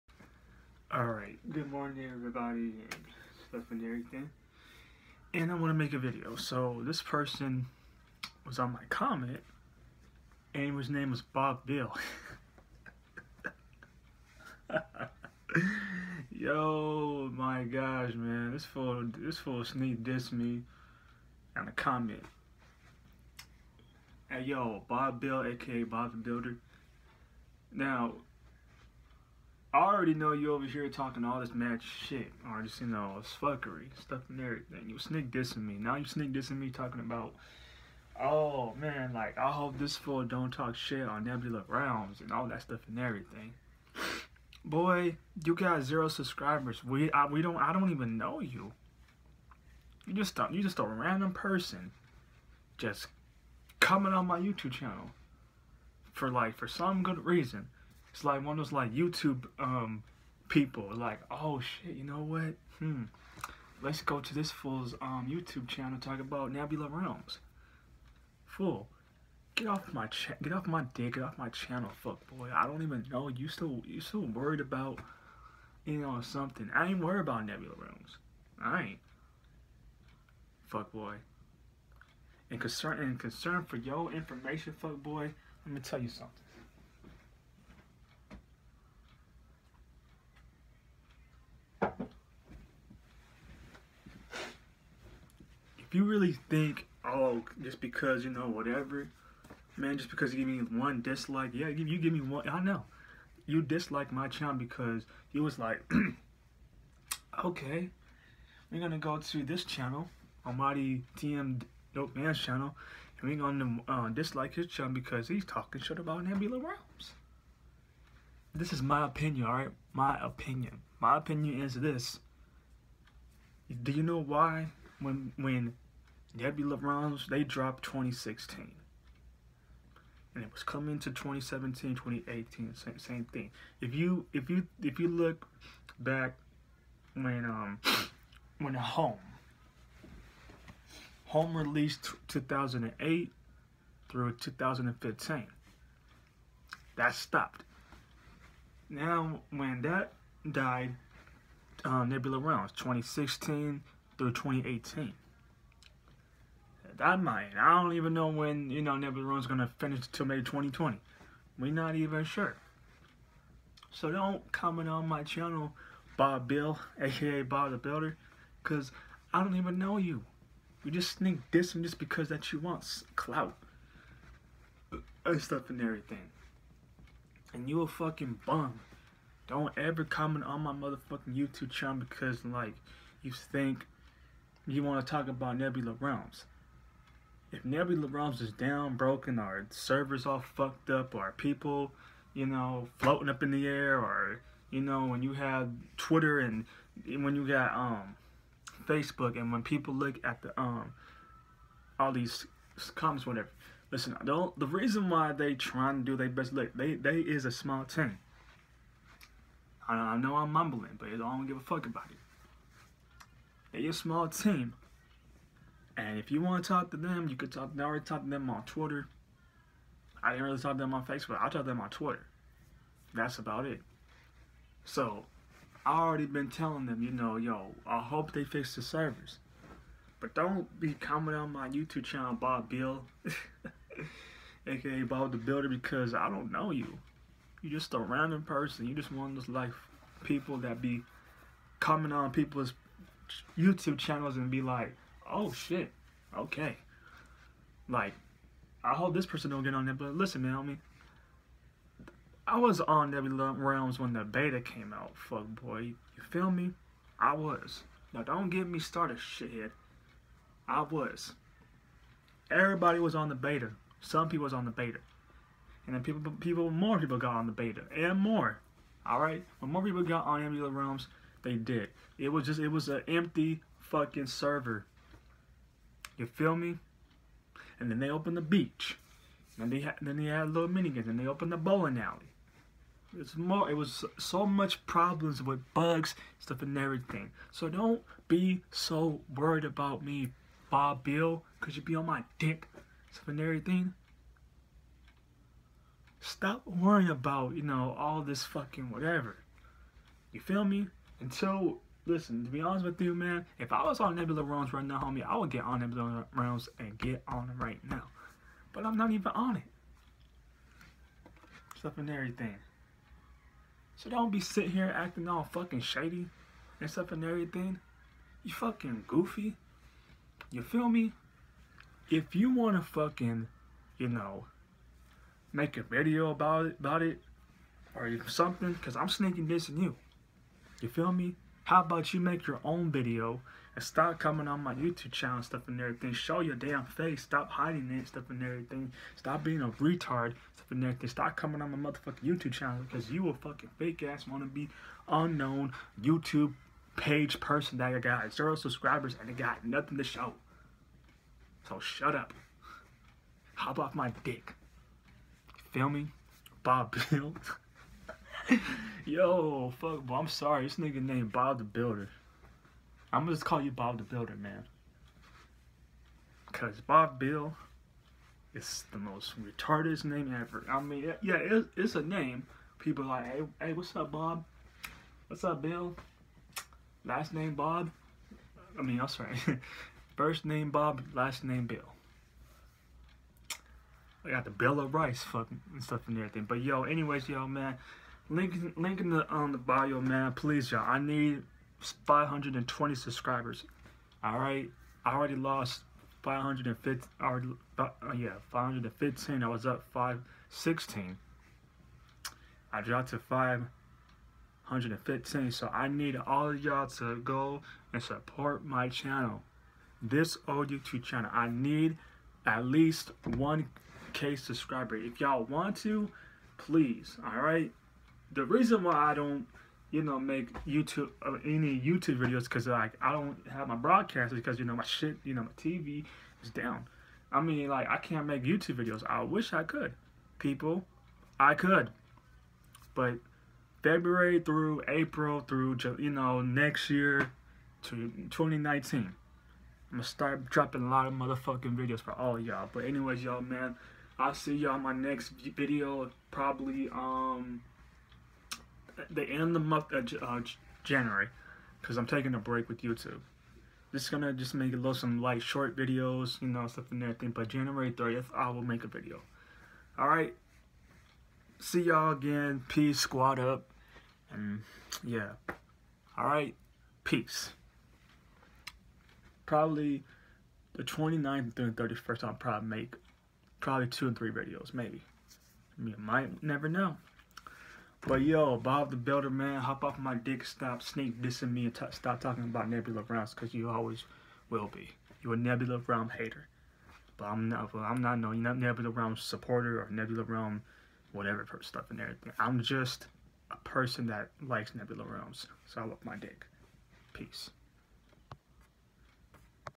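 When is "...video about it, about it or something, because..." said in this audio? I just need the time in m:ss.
5:25.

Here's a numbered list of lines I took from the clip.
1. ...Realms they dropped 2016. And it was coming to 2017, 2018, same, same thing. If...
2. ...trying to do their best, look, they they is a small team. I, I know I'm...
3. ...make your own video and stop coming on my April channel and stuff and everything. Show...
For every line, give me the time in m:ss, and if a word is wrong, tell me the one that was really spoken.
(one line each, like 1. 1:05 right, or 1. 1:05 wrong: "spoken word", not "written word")
1. 2:06 right
2. 3:25 right
3. 5:32 wrong: "YouTube", not "April".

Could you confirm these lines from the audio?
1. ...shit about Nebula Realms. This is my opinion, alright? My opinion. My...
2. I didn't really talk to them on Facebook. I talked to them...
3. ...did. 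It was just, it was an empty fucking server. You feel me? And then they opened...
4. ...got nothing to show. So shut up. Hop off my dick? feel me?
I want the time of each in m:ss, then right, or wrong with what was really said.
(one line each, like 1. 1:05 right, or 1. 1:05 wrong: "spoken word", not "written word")
1. 1:55 right
2. 3:40 right
3. 4:31 right
4. 5:49 right.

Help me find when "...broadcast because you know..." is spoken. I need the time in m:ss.
7:03.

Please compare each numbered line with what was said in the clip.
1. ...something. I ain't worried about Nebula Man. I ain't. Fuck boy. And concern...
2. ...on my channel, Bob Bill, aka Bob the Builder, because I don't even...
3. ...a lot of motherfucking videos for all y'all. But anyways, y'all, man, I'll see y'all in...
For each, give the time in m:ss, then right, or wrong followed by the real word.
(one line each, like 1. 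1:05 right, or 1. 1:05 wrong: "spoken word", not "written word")
1. 1:16 wrong: "Realms", not "Man"
2. 2:44 right
3. 7:20 right.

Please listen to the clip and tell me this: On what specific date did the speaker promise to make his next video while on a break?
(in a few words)
January 30th.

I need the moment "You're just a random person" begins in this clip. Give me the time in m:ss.
3:57.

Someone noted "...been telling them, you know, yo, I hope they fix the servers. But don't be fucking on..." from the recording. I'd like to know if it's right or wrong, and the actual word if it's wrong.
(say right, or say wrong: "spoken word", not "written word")
wrong: "commenting", not "fucking".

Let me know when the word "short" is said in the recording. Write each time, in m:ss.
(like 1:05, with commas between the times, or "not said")
7:35.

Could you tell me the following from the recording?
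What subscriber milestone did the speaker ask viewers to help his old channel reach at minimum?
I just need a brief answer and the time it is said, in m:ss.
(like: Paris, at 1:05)
1k, at 6:53.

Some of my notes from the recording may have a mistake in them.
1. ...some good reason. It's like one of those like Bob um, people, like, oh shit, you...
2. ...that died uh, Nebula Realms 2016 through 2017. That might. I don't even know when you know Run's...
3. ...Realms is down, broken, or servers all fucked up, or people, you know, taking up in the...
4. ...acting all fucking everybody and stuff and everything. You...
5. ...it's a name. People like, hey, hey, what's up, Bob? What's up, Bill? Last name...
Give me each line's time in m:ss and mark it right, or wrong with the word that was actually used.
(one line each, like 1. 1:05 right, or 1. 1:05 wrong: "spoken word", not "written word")
1. 0:56 wrong: "YouTube", not "Bob"
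2. 2:29 wrong: "2018", not "2017"
3. 3:08 wrong: "floating", not "taking"
4. 5:14 wrong: "shady", not "everybody"
5. 6:11 right.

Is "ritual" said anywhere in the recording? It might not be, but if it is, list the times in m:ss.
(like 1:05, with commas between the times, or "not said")
not said.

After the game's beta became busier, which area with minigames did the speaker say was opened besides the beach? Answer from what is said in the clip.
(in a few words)
bowling alley.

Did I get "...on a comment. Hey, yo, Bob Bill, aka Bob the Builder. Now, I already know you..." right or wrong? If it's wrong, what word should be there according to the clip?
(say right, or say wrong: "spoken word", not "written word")
right.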